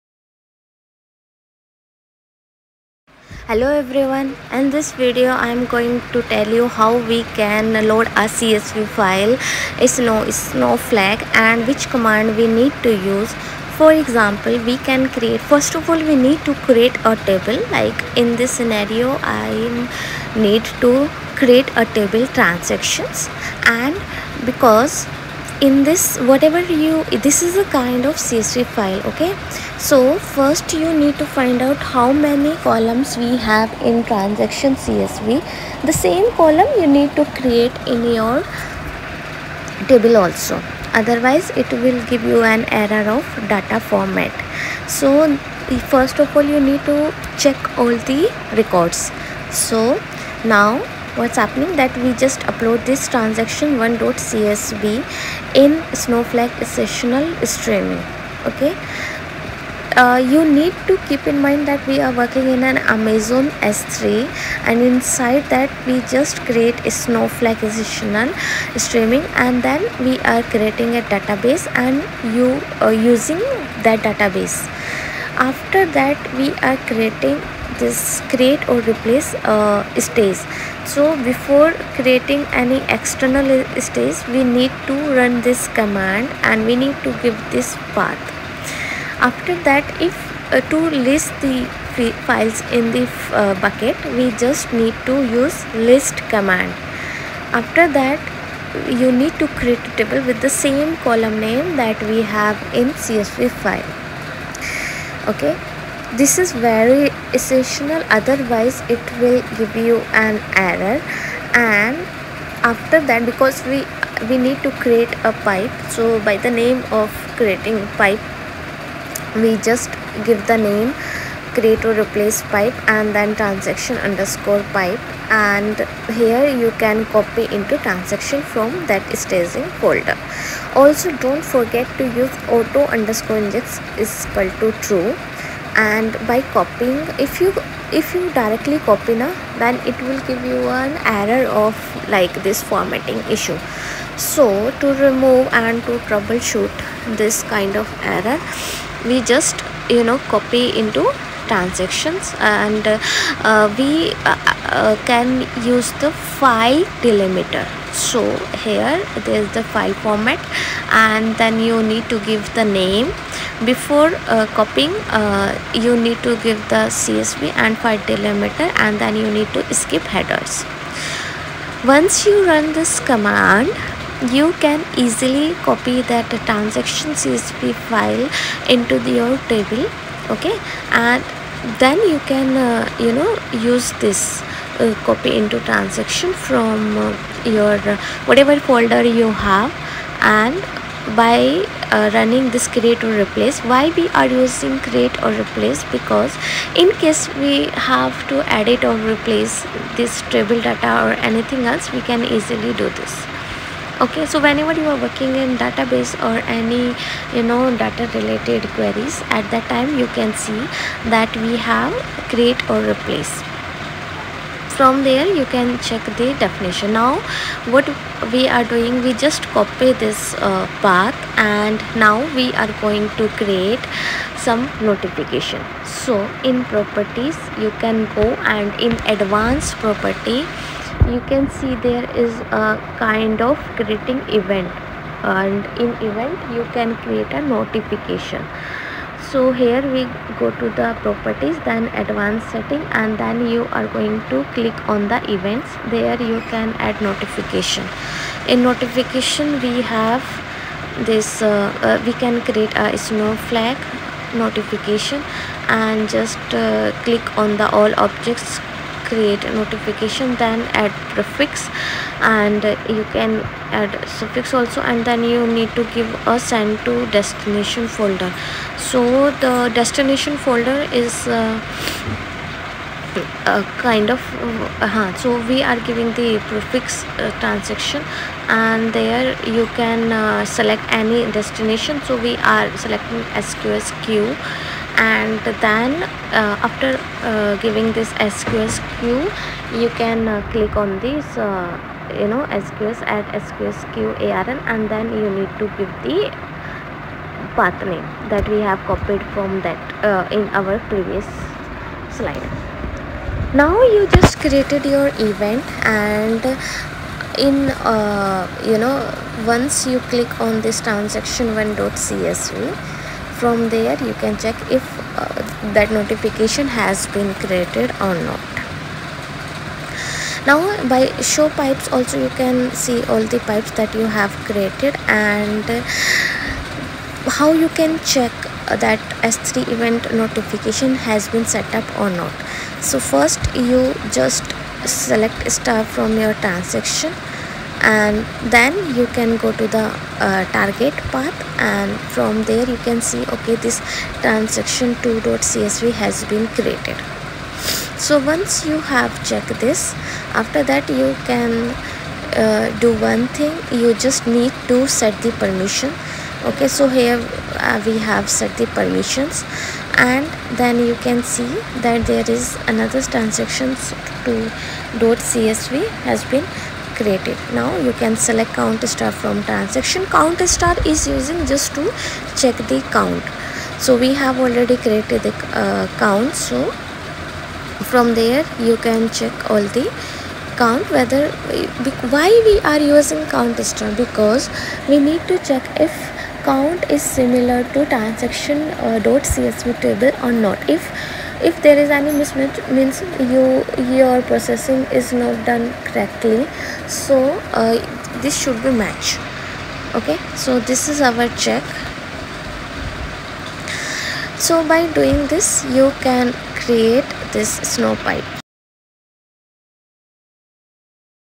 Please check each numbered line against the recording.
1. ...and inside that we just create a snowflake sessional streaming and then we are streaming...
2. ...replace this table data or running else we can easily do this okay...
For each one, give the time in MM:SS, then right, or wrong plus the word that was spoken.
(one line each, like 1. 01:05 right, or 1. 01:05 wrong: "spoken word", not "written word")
1. 01:04 wrong: "creating", not "streaming"
2. 03:19 wrong: "anything", not "running".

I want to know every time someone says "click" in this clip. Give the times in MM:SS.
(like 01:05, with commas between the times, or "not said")
04:04, 04:17, 04:50, 05:10.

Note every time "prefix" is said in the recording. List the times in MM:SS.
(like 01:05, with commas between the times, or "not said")
04:21, 04:36.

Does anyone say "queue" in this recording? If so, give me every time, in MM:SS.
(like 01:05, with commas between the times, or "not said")
04:44, 04:48.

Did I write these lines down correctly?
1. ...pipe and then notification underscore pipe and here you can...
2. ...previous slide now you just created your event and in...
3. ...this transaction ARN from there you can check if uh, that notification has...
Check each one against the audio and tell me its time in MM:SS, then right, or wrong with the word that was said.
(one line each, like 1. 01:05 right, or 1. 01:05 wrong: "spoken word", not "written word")
1. 02:02 wrong: "transaction", not "notification"
2. 05:00 right
3. 05:10 wrong: "CSV", not "ARN".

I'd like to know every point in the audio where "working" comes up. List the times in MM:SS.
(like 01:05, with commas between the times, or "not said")
01:02, 03:24.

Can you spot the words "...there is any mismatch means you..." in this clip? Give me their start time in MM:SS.
06:31.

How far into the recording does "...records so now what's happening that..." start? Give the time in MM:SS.
00:48.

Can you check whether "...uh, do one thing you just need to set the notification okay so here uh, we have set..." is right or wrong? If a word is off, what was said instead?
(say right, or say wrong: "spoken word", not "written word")
wrong: "permission", not "notification".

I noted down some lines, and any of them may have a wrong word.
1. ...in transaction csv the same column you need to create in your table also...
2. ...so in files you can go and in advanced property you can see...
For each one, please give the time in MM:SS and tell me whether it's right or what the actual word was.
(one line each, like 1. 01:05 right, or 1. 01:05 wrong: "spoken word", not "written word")
1. 00:33 right
2. 03:46 wrong: "properties", not "files".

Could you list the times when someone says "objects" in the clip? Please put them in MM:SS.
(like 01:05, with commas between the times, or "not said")
04:17.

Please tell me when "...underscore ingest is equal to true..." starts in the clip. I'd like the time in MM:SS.
02:12.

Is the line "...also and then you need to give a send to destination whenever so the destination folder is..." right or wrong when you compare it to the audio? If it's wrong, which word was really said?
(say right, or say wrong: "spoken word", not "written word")
wrong: "folder", not "whenever".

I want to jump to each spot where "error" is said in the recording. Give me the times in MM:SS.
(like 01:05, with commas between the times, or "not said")
00:42, 01:50, 02:21, 02:28.